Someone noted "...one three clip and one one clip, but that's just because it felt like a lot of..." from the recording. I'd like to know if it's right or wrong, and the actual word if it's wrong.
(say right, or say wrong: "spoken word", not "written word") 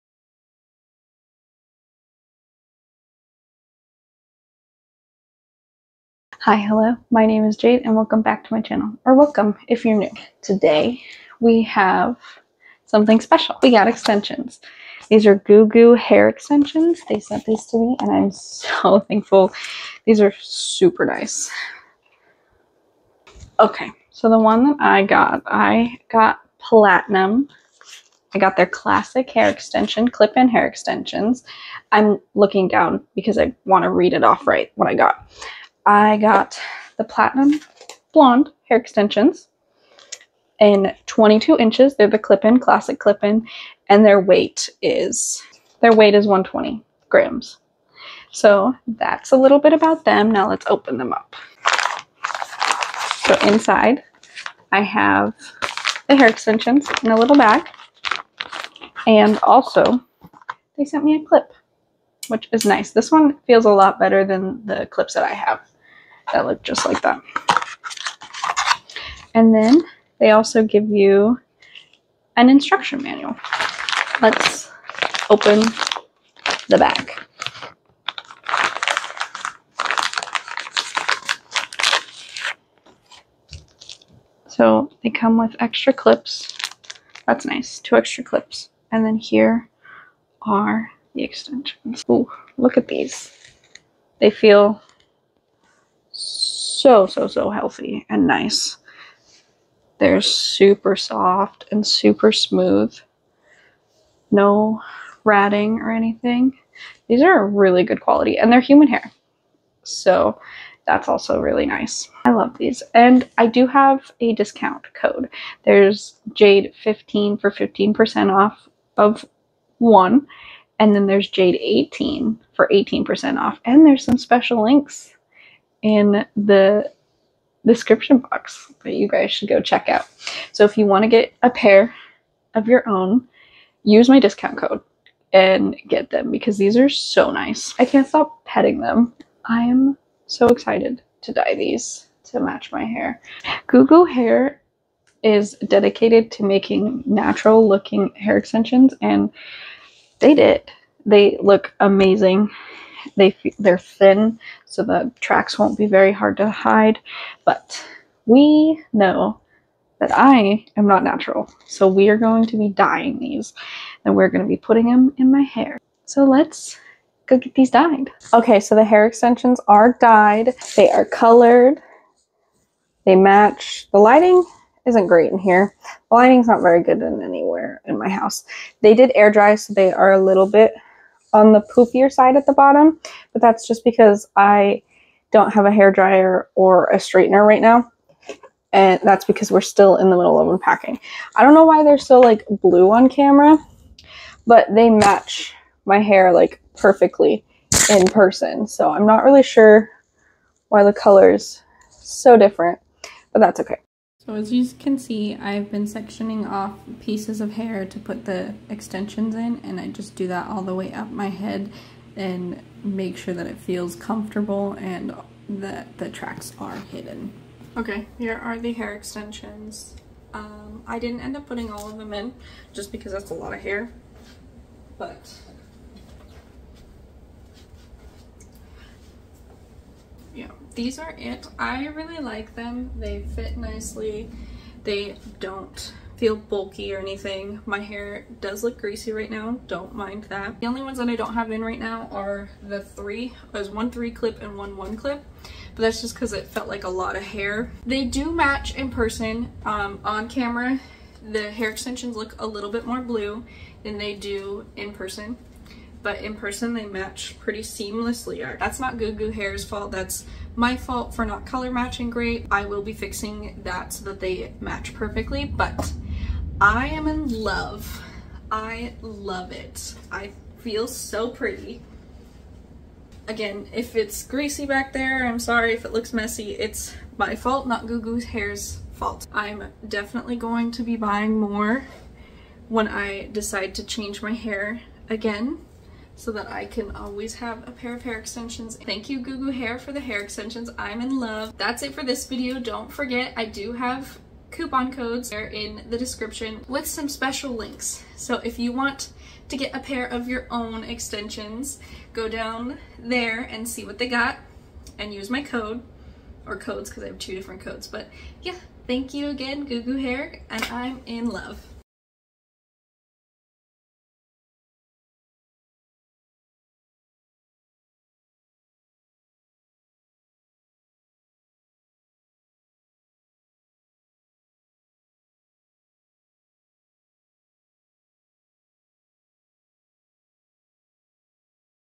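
right.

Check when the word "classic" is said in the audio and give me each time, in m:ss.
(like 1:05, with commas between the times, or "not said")
0:28, 0:42.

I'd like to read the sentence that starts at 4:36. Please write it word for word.
It's my fault, not Goo Goo Hair's fault.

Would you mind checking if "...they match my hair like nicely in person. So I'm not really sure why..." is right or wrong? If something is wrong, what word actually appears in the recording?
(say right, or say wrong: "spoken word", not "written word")
wrong: "perfectly", not "nicely".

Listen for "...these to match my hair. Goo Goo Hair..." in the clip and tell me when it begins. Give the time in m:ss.
2:21.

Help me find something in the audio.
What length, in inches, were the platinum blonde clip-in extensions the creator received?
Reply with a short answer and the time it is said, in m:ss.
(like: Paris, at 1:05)
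22 inches, at 0:41.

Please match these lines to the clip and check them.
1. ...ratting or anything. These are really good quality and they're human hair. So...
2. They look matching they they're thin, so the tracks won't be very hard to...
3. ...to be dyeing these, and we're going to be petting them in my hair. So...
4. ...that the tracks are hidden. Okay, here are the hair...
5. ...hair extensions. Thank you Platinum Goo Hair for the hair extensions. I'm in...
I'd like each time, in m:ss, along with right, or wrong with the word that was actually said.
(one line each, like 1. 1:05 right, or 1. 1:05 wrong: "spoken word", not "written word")
1. 1:45 right
2. 2:31 wrong: "amazing", not "matching"
3. 2:42 wrong: "putting", not "petting"
4. 3:35 right
5. 4:48 wrong: "Goo", not "Platinum".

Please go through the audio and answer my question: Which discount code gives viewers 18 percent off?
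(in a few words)
Jaid18.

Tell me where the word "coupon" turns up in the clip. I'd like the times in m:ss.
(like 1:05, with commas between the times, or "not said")
4:54.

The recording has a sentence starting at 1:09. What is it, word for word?
And then they also give you an instruction manual.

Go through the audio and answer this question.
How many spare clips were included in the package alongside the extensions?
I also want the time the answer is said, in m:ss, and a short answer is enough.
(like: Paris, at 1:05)
2, at 1:27.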